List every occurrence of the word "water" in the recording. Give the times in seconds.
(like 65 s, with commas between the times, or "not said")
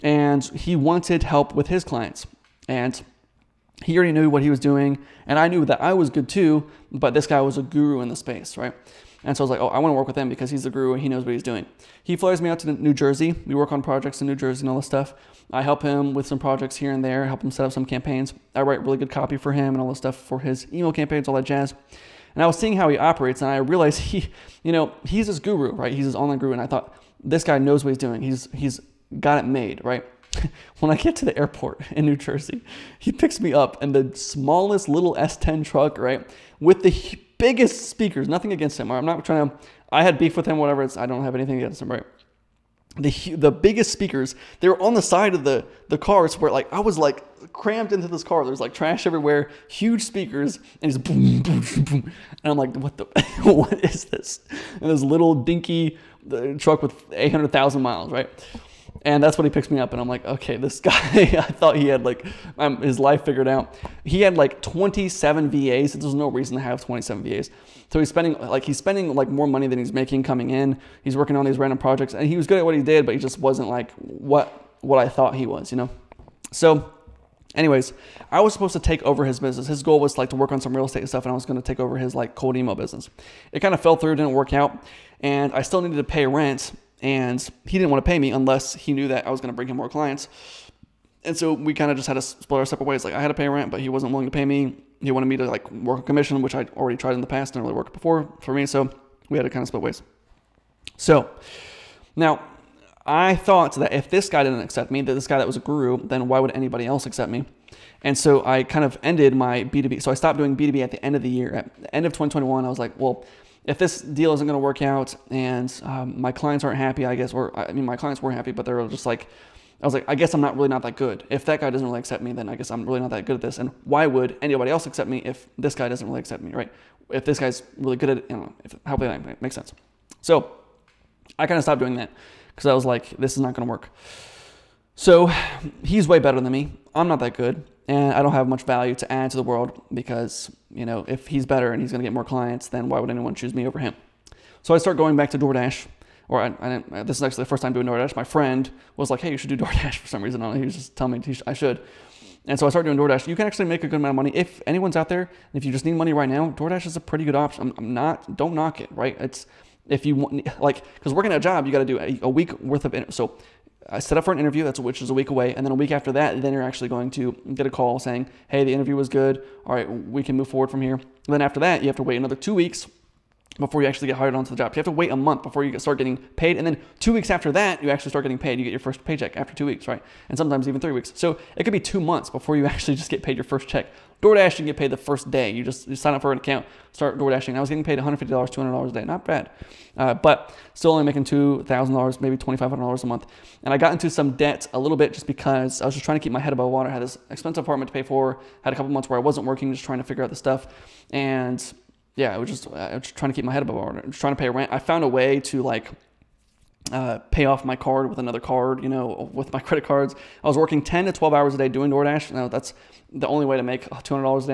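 196 s, 203 s.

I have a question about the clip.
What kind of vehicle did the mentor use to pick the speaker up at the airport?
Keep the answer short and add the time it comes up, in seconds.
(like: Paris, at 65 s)
S10 truck, at 35 s.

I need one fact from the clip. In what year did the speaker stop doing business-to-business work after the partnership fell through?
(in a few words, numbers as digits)
2021.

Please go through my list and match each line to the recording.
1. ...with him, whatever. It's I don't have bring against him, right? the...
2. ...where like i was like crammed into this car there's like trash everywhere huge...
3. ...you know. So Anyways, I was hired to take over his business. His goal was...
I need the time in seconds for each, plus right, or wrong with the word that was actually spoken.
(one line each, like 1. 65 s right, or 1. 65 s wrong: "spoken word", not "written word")
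1. 40 s wrong: "anything", not "bring"
2. 46 s right
3. 75 s wrong: "supposed", not "hired".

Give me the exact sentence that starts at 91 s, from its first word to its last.
And so we kind of just had to split our separate ways.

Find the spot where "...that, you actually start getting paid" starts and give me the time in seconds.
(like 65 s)
177 s.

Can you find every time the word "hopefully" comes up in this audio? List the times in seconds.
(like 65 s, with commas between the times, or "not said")
128 s.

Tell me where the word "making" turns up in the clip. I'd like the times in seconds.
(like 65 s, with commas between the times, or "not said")
69 s, 191 s.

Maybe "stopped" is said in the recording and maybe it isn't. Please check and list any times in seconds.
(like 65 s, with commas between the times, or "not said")
110 s, 131 s.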